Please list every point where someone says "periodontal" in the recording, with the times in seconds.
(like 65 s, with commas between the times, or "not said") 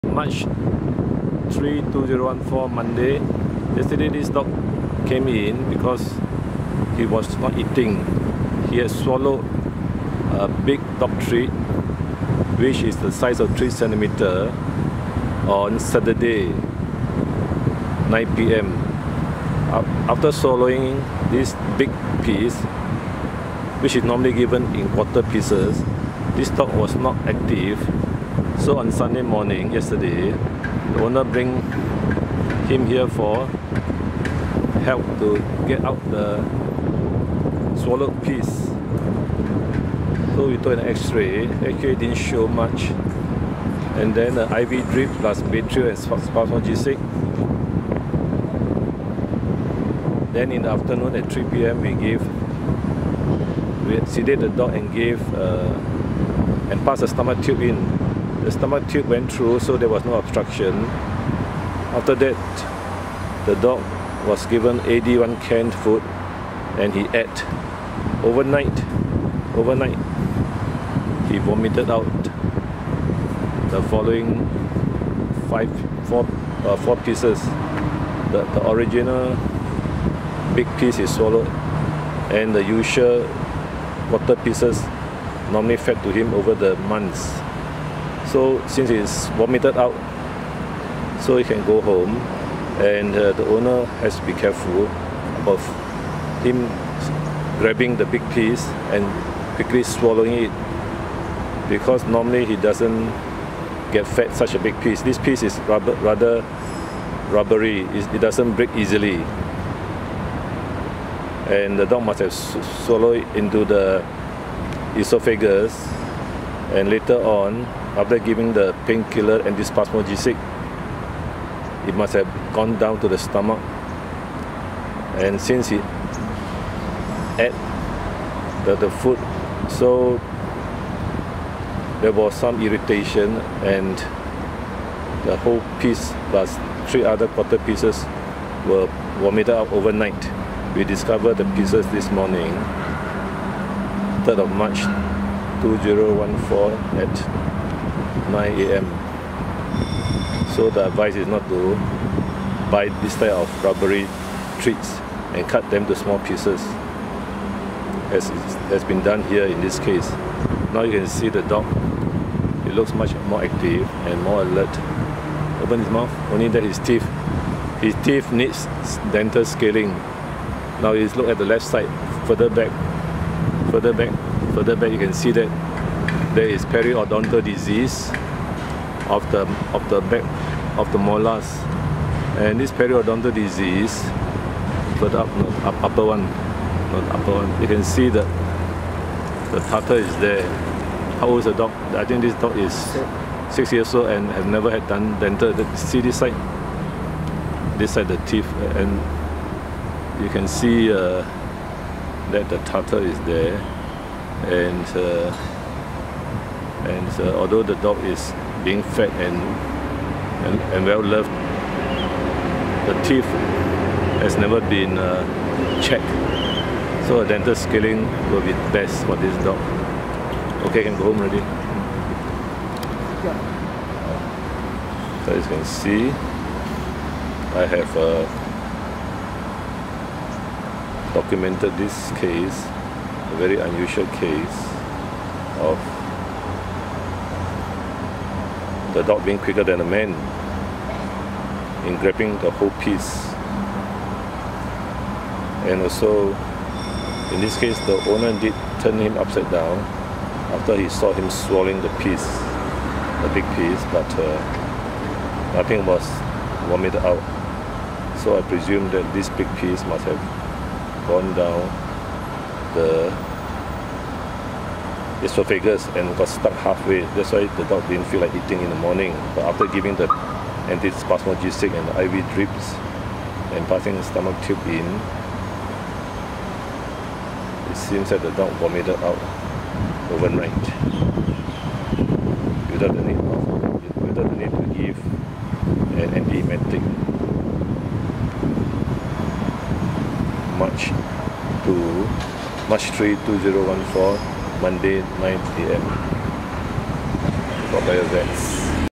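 176 s, 182 s.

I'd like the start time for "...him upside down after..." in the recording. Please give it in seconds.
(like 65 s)
248 s.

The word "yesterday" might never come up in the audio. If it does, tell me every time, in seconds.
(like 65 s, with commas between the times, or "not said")
3 s, 29 s.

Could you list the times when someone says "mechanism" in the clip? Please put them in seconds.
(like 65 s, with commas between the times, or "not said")
not said.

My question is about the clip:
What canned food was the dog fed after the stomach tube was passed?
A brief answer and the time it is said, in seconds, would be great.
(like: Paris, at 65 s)
AD1, at 64 s.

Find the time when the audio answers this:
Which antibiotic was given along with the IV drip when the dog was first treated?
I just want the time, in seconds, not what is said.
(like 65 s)
45 s.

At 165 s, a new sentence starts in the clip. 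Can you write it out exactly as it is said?
Open his mouth, only that his teeth, his teeth needs dental scaling.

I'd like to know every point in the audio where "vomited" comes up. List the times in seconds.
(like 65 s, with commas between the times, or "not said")
71 s, 89 s, 139 s, 256 s, 278 s.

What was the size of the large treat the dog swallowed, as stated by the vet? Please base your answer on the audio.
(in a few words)
3 centimeters.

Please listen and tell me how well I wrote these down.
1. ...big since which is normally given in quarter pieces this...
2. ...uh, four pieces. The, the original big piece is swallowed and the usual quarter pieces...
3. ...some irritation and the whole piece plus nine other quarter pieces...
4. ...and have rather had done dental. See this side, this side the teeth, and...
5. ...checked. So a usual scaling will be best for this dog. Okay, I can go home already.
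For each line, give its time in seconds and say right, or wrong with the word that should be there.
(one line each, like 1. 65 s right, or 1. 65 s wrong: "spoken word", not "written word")
1. 21 s wrong: "piece", not "since"
2. 76 s right
3. 132 s wrong: "three", not "nine"
4. 194 s wrong: "never", not "rather"
5. 215 s wrong: "dental", not "usual".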